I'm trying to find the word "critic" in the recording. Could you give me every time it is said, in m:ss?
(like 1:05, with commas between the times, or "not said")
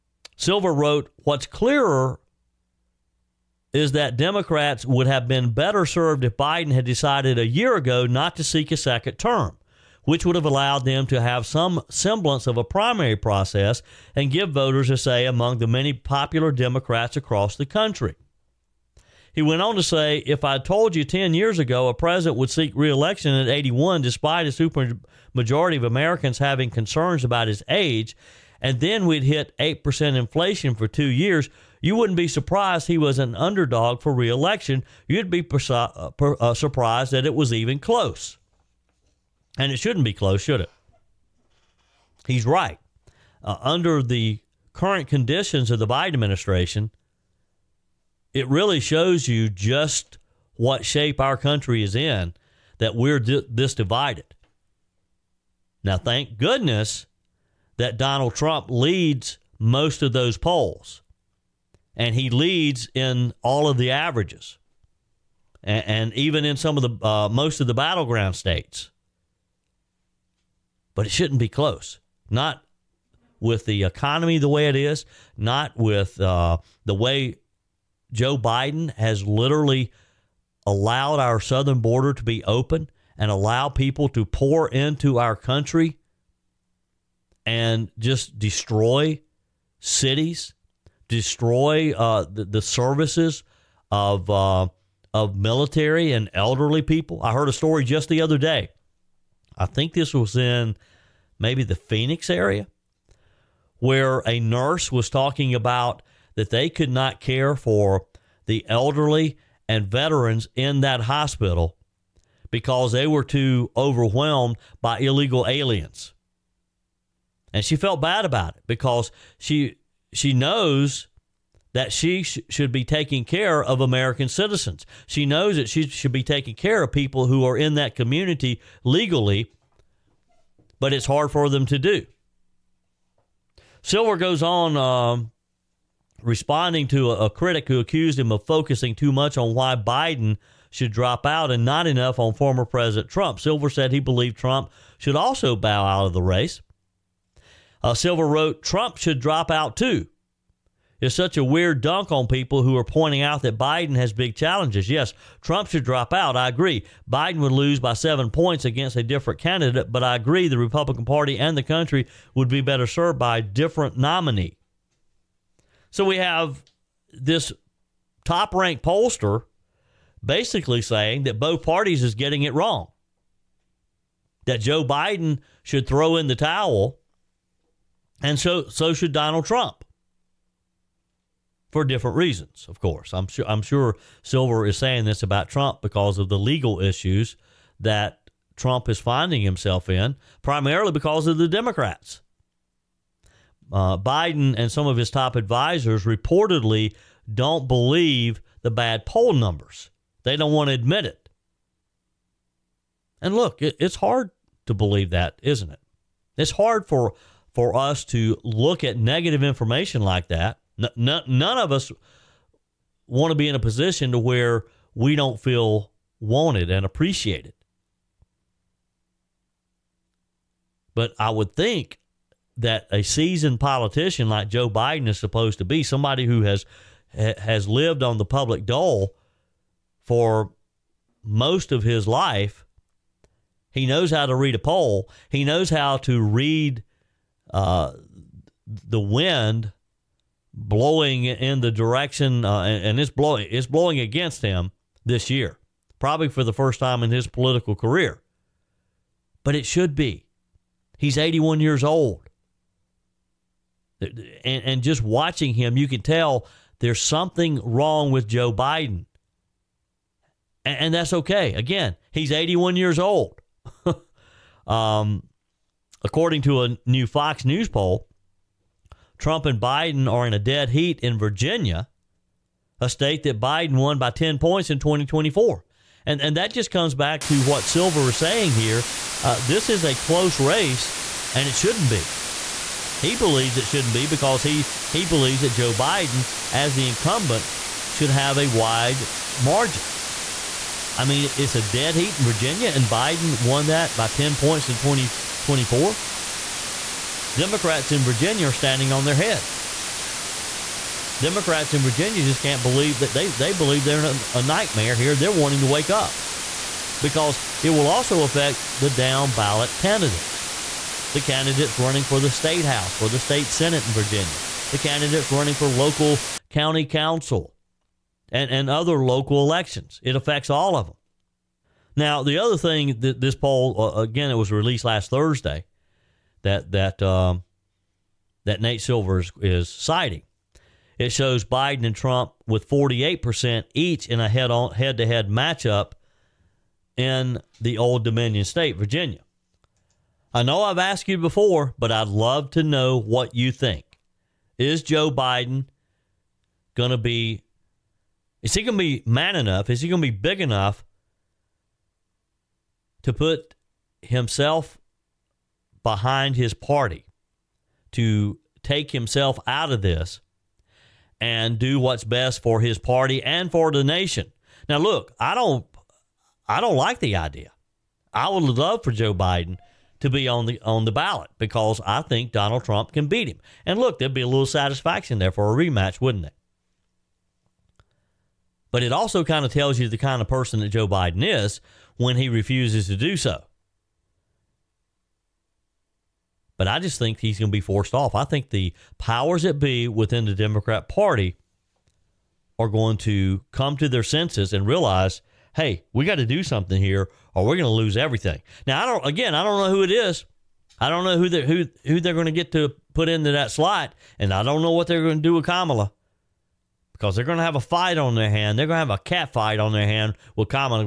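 2:17.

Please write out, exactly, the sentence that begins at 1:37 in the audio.
I heard a story just the other day.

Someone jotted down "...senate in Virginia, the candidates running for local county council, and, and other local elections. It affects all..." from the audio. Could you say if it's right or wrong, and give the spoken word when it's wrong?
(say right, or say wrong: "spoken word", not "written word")
right.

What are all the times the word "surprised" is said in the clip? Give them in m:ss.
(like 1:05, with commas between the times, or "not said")
0:32, 0:36.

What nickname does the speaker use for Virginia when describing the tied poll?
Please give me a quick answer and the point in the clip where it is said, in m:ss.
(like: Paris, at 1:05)
Old Dominion state, at 5:37.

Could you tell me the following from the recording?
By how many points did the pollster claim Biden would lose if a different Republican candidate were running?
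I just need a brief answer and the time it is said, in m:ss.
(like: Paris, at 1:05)
7, at 2:37.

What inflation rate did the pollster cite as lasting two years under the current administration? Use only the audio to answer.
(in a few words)
8%.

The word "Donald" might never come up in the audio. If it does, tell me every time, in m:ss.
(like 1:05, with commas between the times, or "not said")
0:57, 2:59, 6:12.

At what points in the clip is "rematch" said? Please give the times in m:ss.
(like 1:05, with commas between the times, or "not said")
6:15.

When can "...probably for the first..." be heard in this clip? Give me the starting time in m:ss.
4:05.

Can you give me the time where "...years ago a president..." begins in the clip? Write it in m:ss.
0:21.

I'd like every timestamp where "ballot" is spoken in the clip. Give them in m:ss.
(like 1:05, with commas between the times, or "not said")
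5:09, 6:10.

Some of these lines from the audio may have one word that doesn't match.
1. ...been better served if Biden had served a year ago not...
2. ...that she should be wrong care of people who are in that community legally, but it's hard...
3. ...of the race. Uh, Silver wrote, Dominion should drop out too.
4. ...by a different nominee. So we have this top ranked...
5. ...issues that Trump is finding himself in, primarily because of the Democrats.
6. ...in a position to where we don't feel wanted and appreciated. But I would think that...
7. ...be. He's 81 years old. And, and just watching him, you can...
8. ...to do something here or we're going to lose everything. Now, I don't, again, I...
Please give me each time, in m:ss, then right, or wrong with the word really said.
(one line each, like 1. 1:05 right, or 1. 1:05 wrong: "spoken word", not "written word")
1. 0:05 wrong: "decided", not "served"
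2. 2:05 wrong: "taking", not "wrong"
3. 2:26 wrong: "Trump", not "Dominion"
4. 2:43 right
5. 3:06 right
6. 3:33 right
7. 4:09 right
8. 6:36 right.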